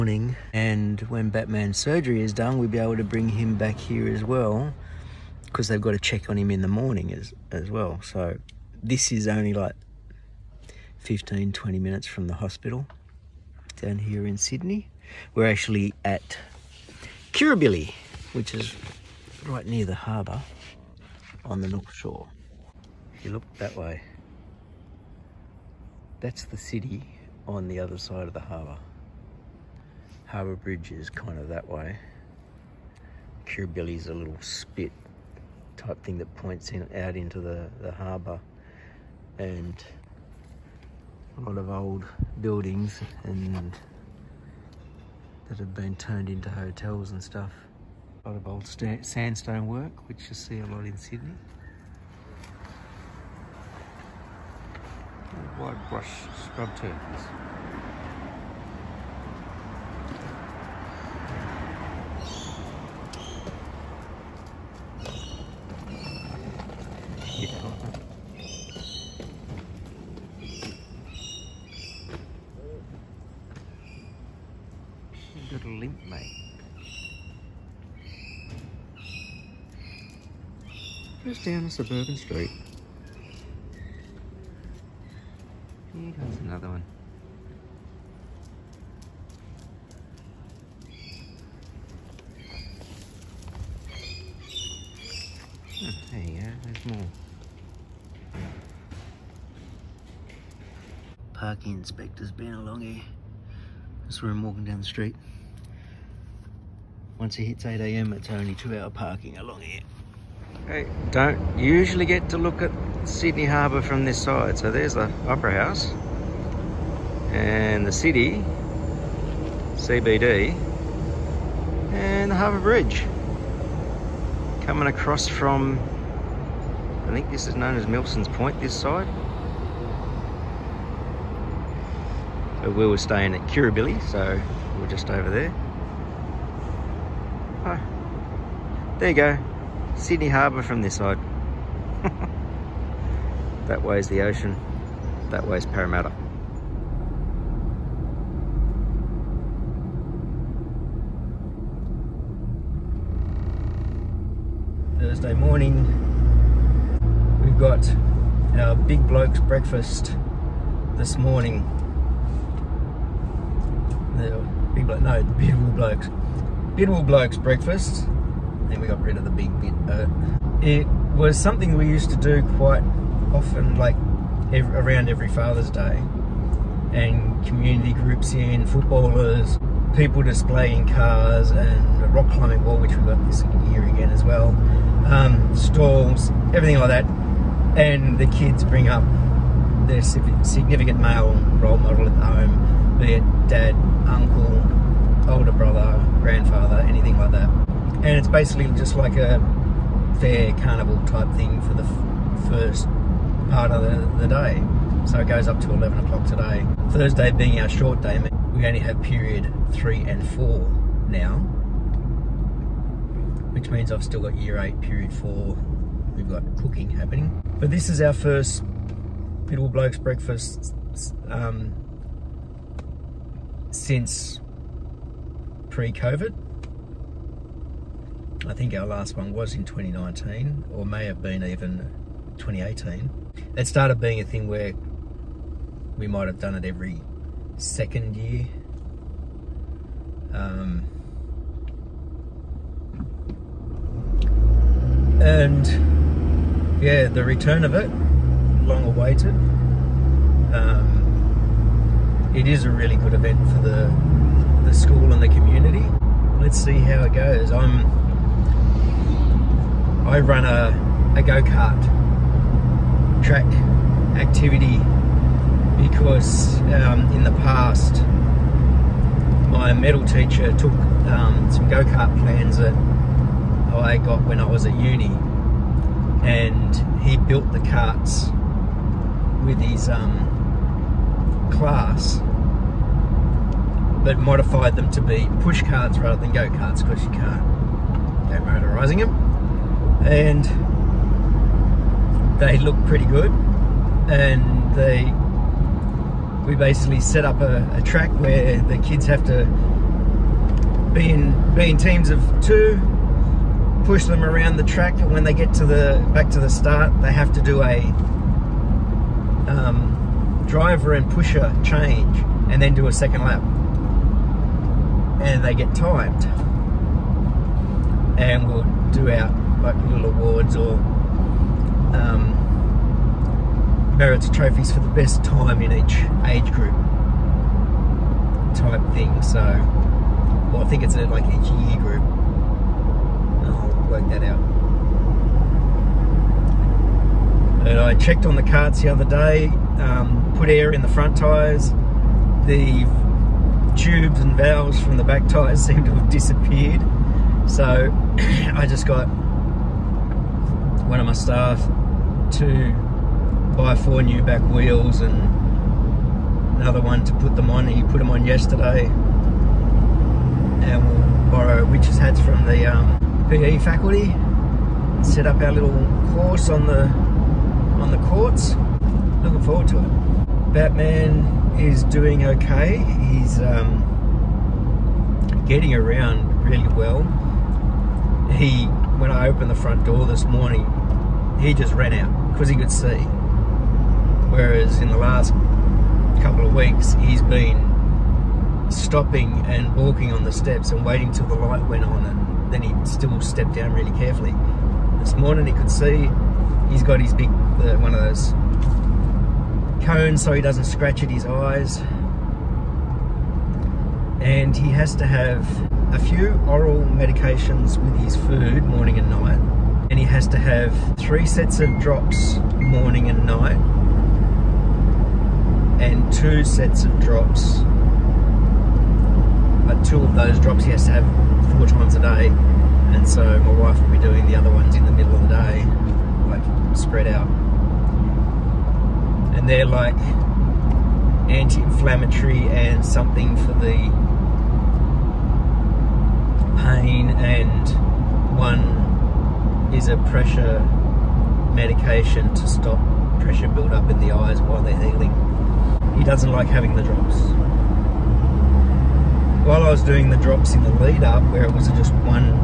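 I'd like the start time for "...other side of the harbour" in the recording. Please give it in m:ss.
0:27.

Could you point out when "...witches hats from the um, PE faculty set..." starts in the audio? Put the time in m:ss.
6:01.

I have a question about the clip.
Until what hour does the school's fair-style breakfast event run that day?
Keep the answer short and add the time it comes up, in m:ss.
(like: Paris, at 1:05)
11 o'clock, at 3:25.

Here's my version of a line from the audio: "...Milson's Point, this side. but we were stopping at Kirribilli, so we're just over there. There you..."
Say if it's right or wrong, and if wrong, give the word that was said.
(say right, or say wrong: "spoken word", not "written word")
wrong: "staying", not "stopping".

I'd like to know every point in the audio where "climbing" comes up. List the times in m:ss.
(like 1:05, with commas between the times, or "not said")
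3:02.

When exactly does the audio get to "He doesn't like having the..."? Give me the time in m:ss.
7:25.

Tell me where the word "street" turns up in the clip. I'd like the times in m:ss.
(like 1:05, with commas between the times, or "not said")
1:22, 1:44.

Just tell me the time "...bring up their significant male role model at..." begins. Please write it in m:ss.
3:08.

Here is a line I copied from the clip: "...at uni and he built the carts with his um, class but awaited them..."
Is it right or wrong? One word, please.
wrong.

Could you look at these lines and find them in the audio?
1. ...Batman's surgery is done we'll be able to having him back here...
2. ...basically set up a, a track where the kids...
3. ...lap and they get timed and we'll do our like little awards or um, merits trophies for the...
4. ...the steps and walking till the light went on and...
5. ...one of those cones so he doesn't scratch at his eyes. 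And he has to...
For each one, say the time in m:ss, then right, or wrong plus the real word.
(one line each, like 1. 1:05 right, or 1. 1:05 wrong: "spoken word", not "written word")
1. 0:01 wrong: "bring", not "having"
2. 4:56 right
3. 5:13 right
4. 6:30 wrong: "waiting", not "walking"
5. 6:37 right.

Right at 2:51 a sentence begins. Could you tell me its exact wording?
was something we used to do quite often, like every, around every Father's Day.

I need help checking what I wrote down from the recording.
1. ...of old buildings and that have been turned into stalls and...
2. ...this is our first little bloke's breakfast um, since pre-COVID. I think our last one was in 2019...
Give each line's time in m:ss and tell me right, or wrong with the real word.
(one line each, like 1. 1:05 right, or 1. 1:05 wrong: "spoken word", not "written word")
1. 0:41 wrong: "hotels", not "stalls"
2. 3:37 right.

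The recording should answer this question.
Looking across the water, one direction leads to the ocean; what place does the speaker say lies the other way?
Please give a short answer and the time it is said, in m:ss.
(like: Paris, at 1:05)
Parramatta, at 2:25.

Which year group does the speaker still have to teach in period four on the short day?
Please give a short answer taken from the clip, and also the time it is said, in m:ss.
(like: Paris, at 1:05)
Year 8, at 3:34.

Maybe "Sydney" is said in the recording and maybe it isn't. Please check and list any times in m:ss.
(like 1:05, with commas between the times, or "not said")
0:14, 0:50, 1:53, 2:19.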